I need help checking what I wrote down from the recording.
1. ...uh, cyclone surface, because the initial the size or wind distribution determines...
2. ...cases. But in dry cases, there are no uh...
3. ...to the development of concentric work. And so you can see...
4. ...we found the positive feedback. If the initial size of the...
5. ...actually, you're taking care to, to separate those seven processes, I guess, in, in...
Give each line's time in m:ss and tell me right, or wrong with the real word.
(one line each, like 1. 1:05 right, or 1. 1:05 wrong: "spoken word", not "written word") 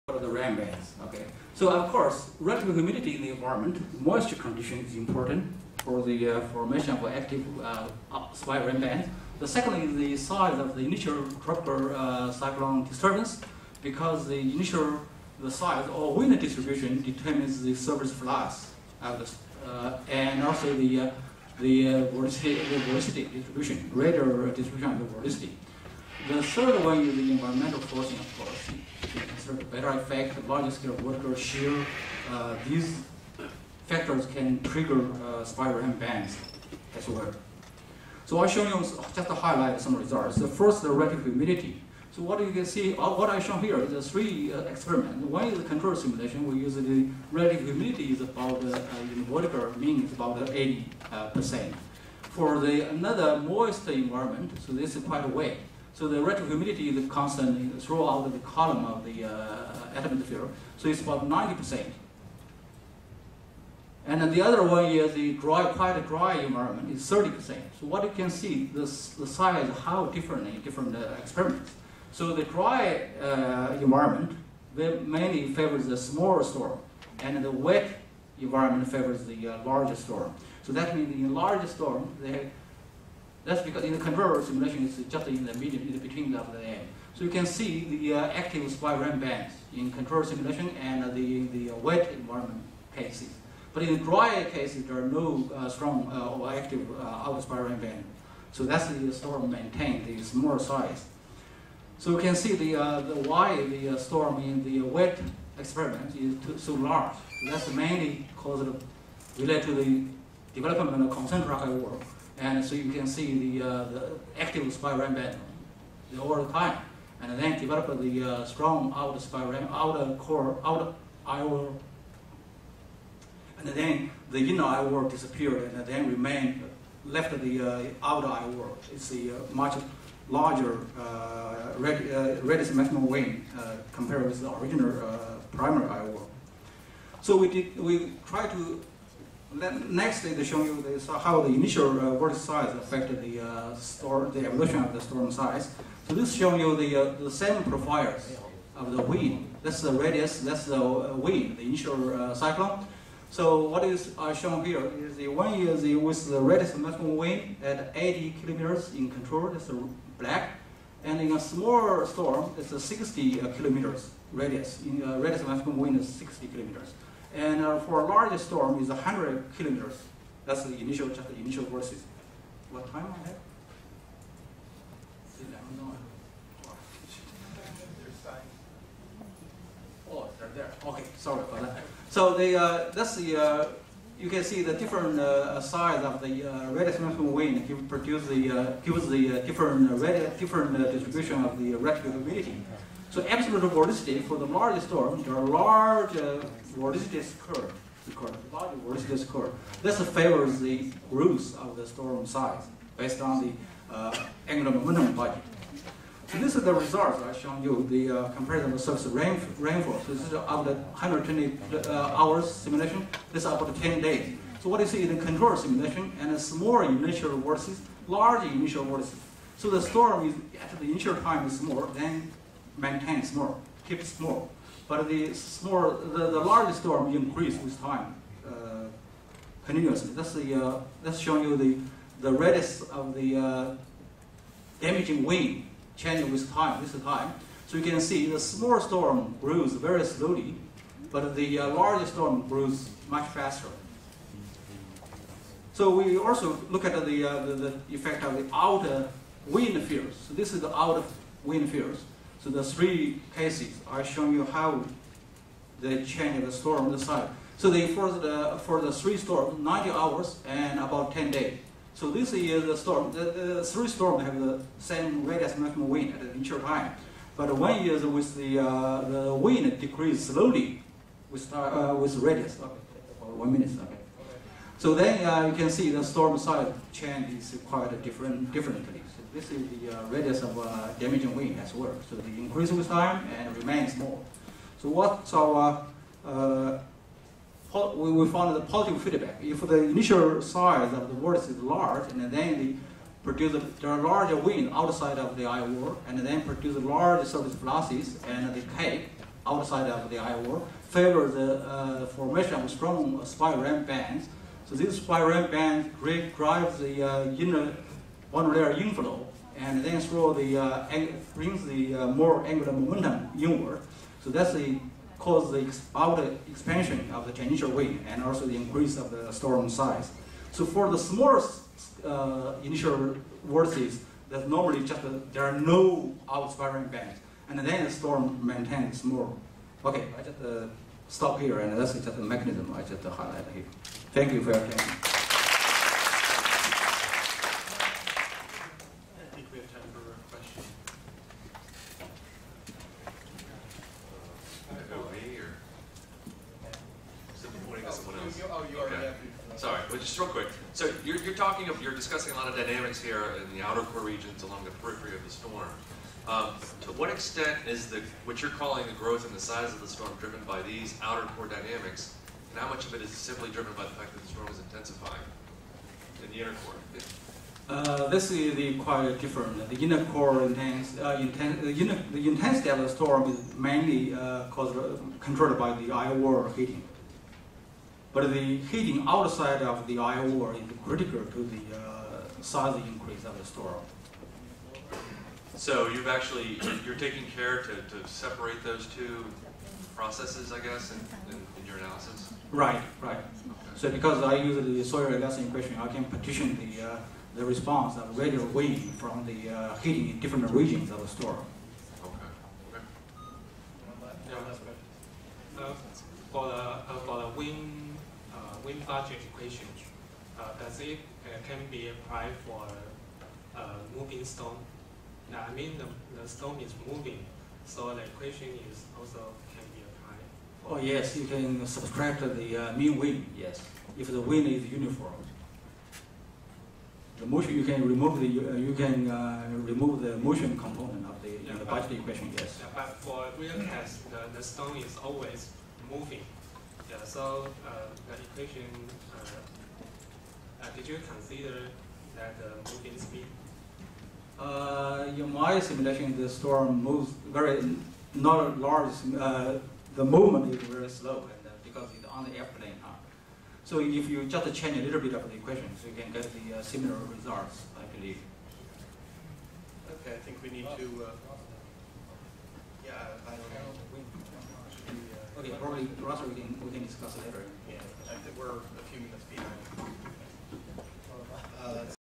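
1. 0:11 wrong: "disturbance", not "surface"
2. 1:32 right
3. 1:49 right
4. 4:48 right
5. 6:26 wrong: "two", not "seven".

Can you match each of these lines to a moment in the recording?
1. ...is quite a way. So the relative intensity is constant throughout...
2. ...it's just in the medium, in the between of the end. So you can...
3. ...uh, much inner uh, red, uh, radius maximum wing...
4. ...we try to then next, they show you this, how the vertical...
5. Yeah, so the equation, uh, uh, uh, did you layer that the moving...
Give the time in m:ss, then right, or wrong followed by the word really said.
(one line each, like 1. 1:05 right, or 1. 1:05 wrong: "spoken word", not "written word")
1. 0:54 wrong: "humidity", not "intensity"
2. 1:24 right
3. 2:09 wrong: "larger", not "inner"
4. 2:17 wrong: "initial", not "vertical"
5. 7:16 wrong: "consider", not "layer".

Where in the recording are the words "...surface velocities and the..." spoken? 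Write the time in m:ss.
4:57.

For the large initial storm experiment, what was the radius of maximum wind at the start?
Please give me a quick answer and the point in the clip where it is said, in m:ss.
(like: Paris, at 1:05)
100 kilometers, at 2:48.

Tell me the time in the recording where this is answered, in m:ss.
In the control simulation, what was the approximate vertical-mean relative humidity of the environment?
0:50.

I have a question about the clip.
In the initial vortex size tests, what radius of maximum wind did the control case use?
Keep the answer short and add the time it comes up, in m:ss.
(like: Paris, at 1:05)
80 kilometers, at 2:37.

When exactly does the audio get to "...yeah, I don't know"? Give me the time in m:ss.
7:42.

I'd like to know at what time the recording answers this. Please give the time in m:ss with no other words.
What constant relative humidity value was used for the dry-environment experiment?
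1:07.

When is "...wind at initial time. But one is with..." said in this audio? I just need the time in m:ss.
4:25.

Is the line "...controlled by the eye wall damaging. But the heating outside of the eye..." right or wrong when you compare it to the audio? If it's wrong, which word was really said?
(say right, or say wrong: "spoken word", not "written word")
wrong: "heating", not "damaging".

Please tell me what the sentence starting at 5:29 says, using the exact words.
Okay, I just uh, stop here, and that's just a mechanism I just highlight here.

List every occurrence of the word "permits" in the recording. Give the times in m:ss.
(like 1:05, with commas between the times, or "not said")
not said.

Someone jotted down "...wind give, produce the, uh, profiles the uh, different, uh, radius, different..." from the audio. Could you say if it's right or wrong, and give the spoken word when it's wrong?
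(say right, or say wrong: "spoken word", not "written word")
wrong: "gives", not "profiles".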